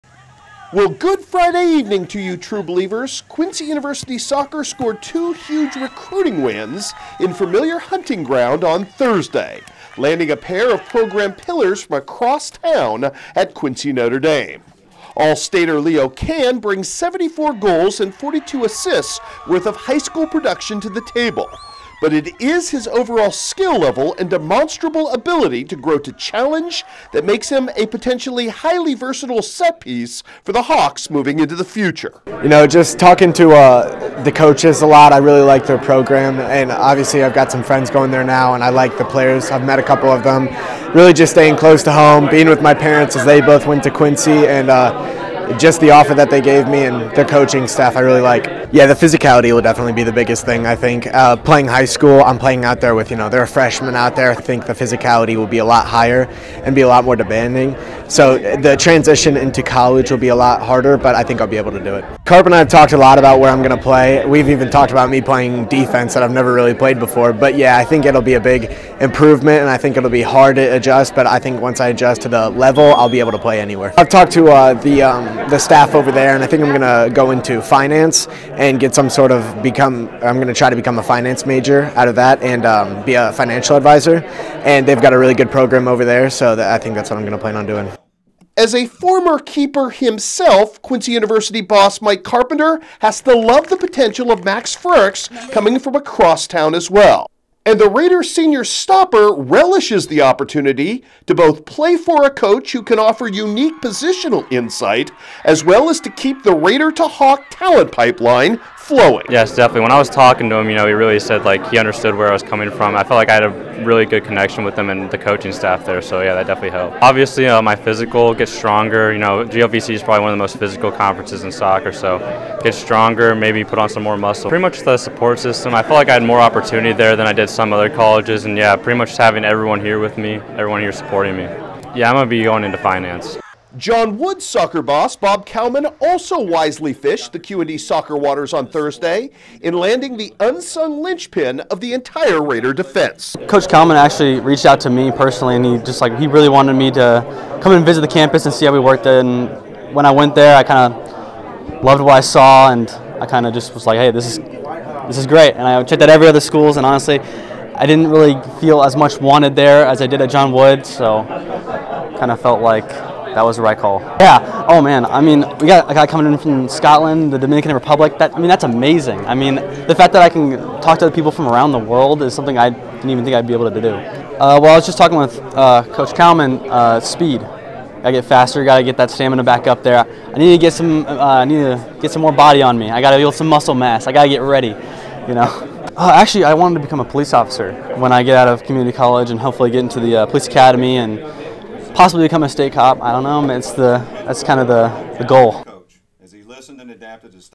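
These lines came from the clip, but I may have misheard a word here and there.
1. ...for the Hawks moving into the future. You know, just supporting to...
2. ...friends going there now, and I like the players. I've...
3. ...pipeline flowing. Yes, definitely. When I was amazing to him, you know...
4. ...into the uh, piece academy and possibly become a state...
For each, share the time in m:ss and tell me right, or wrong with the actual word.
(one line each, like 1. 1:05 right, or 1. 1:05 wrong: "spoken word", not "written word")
1. 0:30 wrong: "talking", not "supporting"
2. 0:37 right
3. 1:47 wrong: "talking", not "amazing"
4. 3:09 wrong: "police", not "piece".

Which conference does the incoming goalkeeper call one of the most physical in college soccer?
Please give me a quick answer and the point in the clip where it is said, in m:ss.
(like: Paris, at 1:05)
GLVC, at 1:59.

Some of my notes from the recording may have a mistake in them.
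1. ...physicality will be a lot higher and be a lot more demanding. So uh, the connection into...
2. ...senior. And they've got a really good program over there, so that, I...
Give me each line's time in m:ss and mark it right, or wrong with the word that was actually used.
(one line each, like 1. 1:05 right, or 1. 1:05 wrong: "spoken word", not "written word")
1. 0:54 wrong: "transition", not "connection"
2. 1:23 wrong: "advisor", not "senior".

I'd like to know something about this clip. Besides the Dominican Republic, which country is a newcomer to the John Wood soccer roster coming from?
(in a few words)
Scotland.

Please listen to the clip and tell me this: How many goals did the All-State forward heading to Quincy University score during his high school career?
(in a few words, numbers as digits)
74.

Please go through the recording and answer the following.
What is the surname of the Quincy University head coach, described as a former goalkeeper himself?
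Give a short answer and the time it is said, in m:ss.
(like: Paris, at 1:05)
Carpenter, at 1:32.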